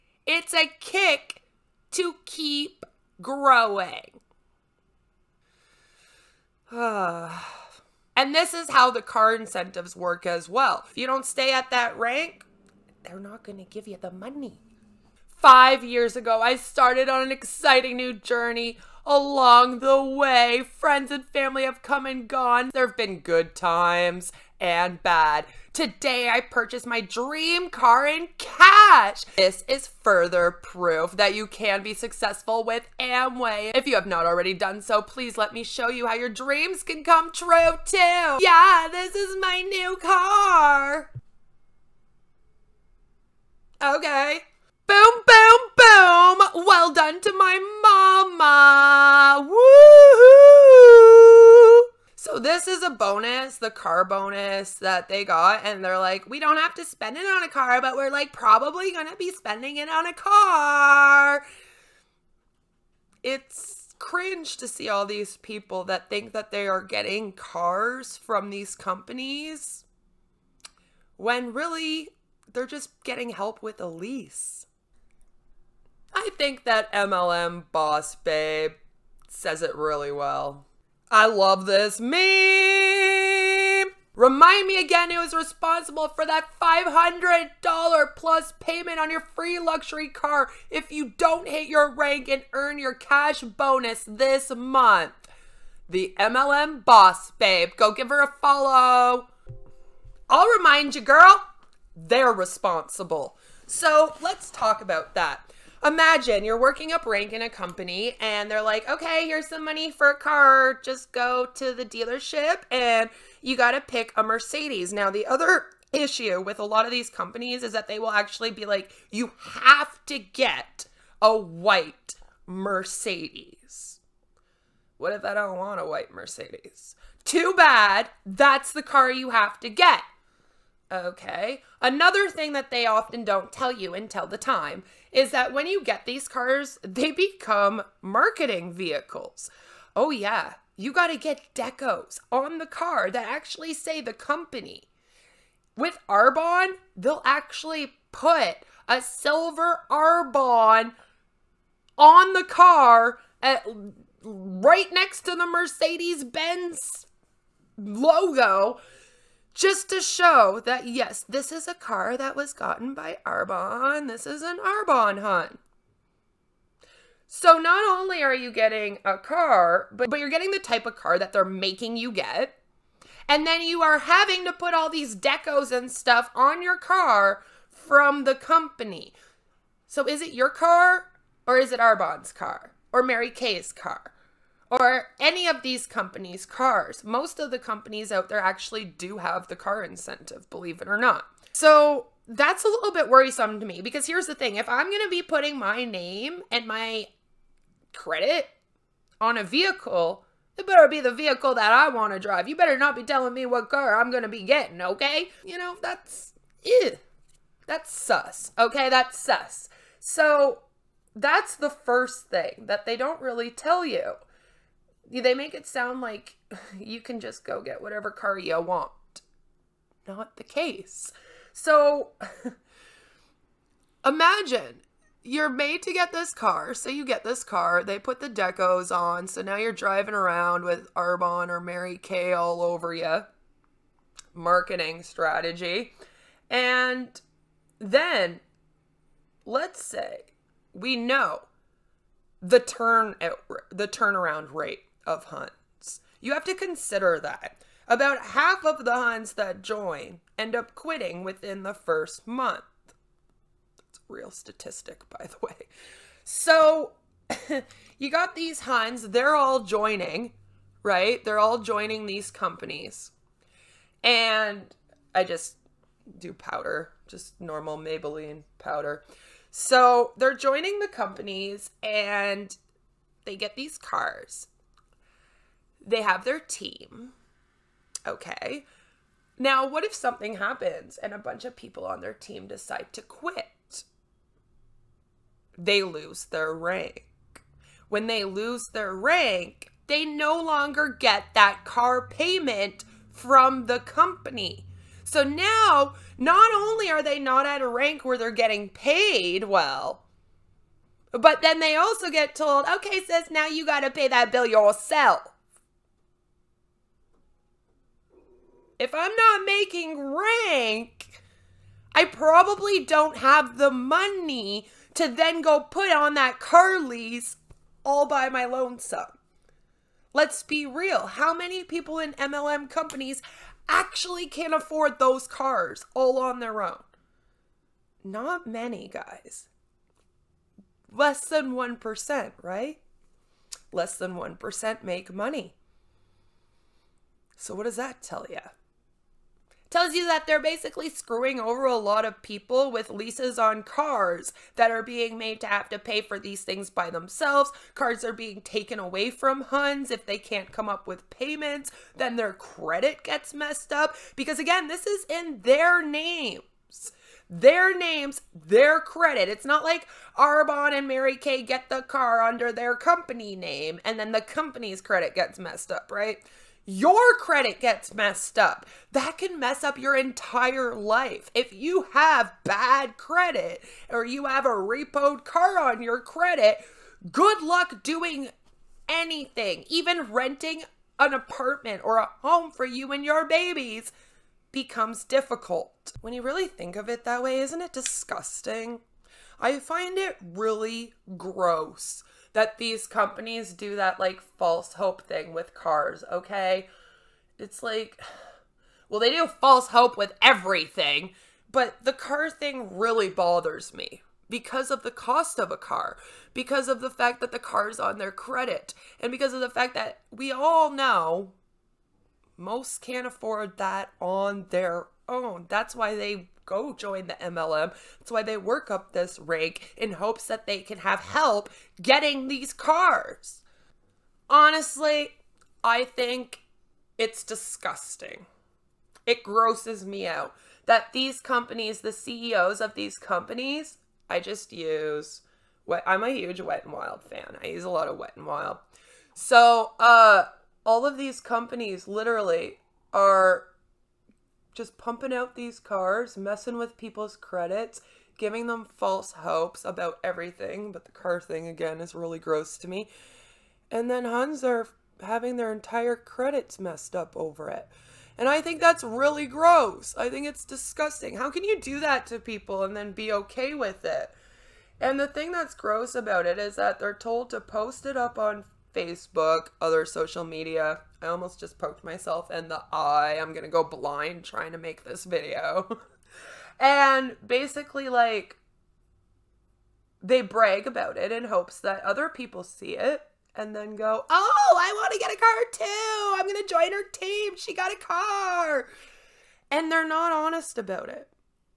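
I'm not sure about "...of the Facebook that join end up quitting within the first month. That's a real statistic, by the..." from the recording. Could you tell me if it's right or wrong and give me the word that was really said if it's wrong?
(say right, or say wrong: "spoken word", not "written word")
wrong: "Huns", not "Facebook".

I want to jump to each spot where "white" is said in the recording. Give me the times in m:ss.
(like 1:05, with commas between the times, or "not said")
2:01, 2:05.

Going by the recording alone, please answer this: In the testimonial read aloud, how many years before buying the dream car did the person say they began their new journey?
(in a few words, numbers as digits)
5.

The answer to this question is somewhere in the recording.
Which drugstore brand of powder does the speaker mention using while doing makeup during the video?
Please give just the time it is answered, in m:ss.
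4:27.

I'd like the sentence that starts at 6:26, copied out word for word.
When you really think of it that way, isn't it disgusting?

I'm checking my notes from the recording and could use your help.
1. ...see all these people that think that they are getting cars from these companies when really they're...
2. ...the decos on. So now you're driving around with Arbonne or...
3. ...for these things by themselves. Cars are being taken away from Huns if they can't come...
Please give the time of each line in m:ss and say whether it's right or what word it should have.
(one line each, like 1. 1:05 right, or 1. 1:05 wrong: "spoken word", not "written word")
1. 1:04 right
2. 3:48 right
3. 5:45 right.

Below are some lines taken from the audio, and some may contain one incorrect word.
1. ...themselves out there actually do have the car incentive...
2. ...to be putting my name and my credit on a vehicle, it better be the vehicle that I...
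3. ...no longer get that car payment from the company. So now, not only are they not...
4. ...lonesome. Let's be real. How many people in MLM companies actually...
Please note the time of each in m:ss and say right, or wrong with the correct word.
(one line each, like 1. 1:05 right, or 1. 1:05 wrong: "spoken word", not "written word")
1. 3:07 wrong: "companies", not "themselves"
2. 3:15 right
3. 4:50 right
4. 5:18 right.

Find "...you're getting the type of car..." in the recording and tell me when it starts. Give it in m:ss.
2:50.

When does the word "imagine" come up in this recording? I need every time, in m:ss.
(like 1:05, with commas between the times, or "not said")
1:45, 3:44.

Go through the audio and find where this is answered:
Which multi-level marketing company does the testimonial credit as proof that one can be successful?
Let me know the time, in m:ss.
0:32.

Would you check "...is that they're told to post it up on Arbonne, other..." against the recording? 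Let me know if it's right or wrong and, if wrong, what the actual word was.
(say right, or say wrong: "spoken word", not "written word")
wrong: "Facebook", not "Arbonne".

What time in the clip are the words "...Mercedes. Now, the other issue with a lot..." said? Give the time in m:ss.
1:54.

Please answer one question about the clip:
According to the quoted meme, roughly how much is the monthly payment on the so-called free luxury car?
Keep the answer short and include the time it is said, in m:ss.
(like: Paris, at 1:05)
$500, at 1:26.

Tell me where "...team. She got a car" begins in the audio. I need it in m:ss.
8:06.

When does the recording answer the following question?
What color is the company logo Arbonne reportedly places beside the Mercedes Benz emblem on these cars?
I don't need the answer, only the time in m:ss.
2:29.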